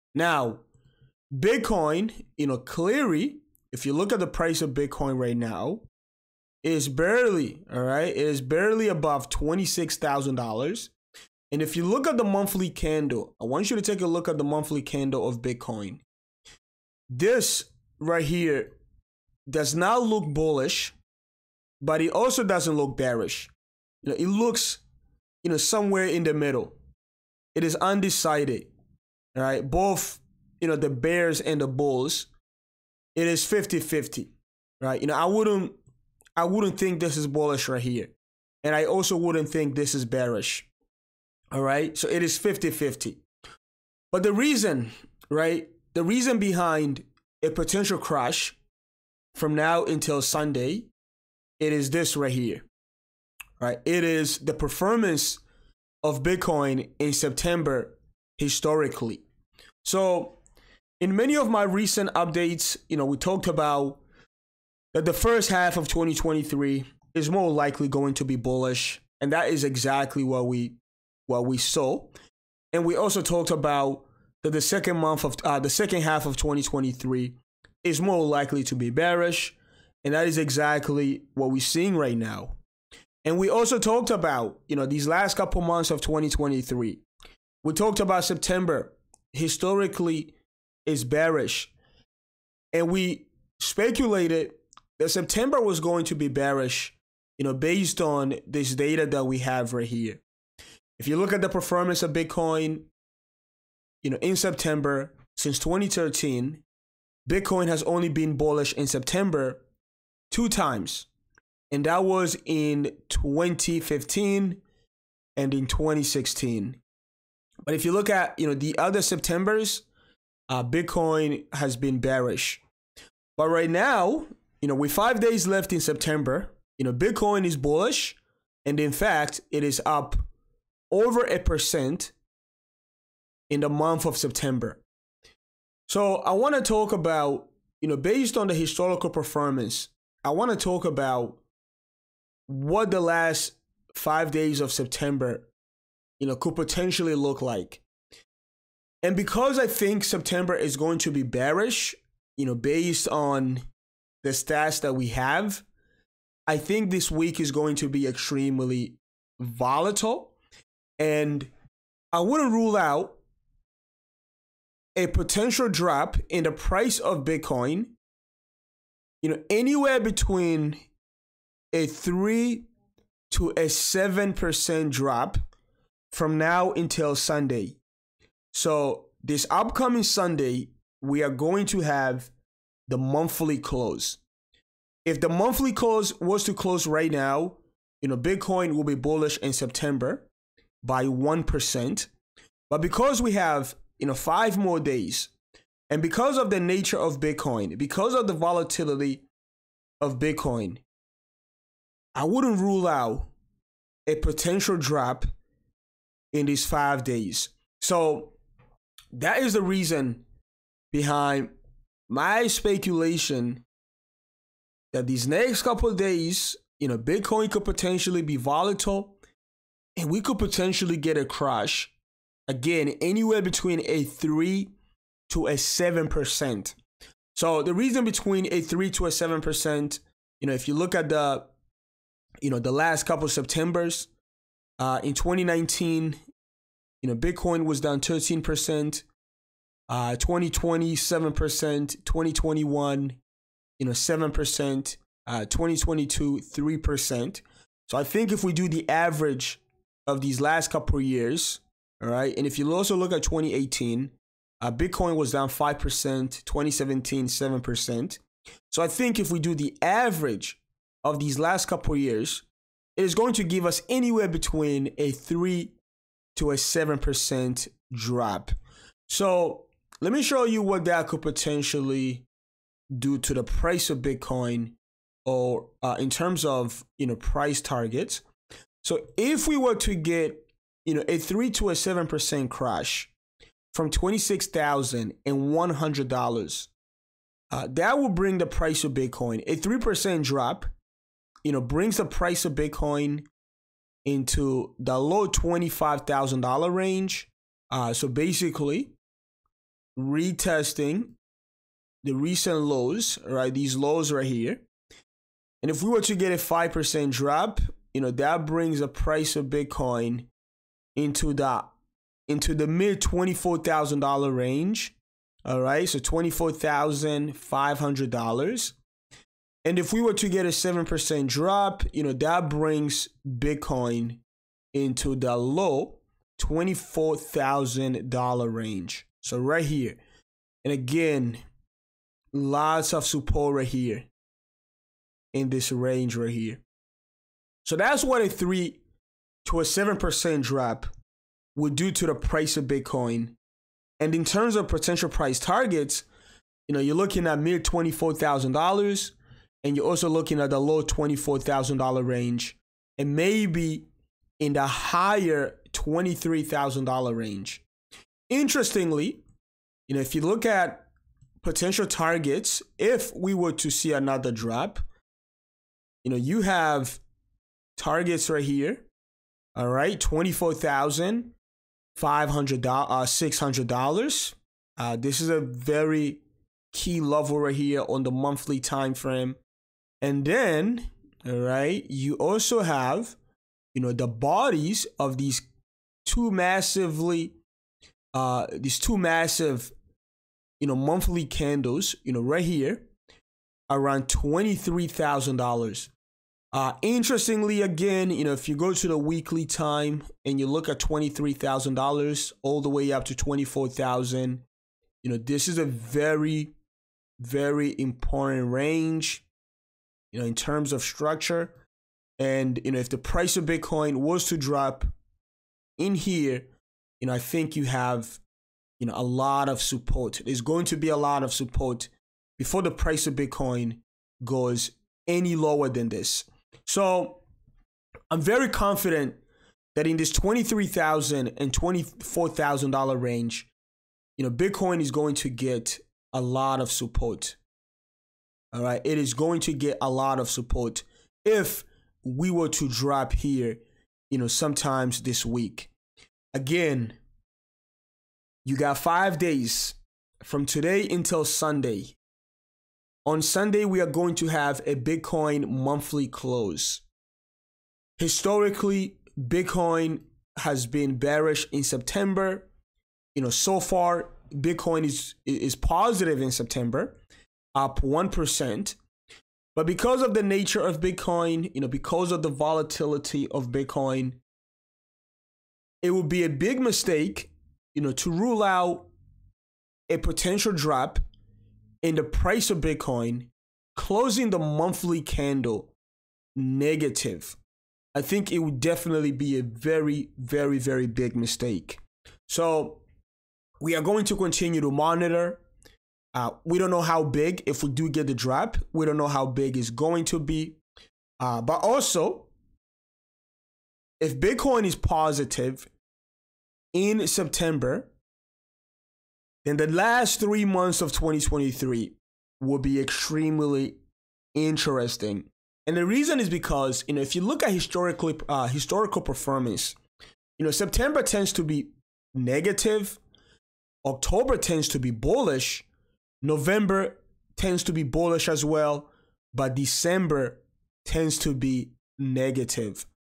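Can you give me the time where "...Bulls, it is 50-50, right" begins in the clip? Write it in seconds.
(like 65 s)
31 s.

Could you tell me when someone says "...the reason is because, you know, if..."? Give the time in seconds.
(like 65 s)
515 s.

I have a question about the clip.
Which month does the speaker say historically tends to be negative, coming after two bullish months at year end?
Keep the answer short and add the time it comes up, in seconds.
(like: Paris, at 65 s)
December, at 529 s.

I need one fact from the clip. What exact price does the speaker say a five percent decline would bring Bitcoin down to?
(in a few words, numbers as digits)
$24,500.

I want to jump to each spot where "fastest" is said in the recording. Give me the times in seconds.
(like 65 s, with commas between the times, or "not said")
not said.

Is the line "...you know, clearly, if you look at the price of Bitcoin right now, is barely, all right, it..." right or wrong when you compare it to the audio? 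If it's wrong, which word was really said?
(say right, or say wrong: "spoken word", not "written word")
right.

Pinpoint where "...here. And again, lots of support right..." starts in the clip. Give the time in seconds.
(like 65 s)
329 s.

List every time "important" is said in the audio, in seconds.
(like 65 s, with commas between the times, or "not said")
407 s.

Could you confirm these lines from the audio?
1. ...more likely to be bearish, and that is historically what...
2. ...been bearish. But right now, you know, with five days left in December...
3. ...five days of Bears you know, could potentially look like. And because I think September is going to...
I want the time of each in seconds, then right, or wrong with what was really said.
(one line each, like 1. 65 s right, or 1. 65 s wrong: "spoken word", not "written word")
1. 78 s wrong: "exactly", not "historically"
2. 121 s wrong: "September", not "December"
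3. 143 s wrong: "September", not "Bears".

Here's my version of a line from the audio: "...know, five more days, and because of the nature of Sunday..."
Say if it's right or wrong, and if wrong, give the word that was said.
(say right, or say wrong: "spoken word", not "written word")
wrong: "Bitcoin", not "Sunday".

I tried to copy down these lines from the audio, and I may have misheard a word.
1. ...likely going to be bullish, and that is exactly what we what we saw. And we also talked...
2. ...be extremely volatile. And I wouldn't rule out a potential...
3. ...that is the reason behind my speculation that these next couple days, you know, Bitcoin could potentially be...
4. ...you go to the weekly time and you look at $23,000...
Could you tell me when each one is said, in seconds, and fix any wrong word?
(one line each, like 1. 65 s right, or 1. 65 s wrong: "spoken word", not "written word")
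1. 67 s right
2. 157 s right
3. 209 s right
4. 398 s right.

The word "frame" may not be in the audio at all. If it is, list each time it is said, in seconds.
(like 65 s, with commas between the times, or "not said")
378 s.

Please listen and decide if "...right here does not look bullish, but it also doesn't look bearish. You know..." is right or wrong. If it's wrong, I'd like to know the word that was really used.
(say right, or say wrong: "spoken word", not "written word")
right.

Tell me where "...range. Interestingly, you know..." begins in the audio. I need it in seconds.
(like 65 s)
357 s.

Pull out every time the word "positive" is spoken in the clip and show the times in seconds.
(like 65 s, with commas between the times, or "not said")
465 s, 504 s.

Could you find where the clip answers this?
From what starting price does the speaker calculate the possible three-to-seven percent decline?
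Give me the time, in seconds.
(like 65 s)
283 s.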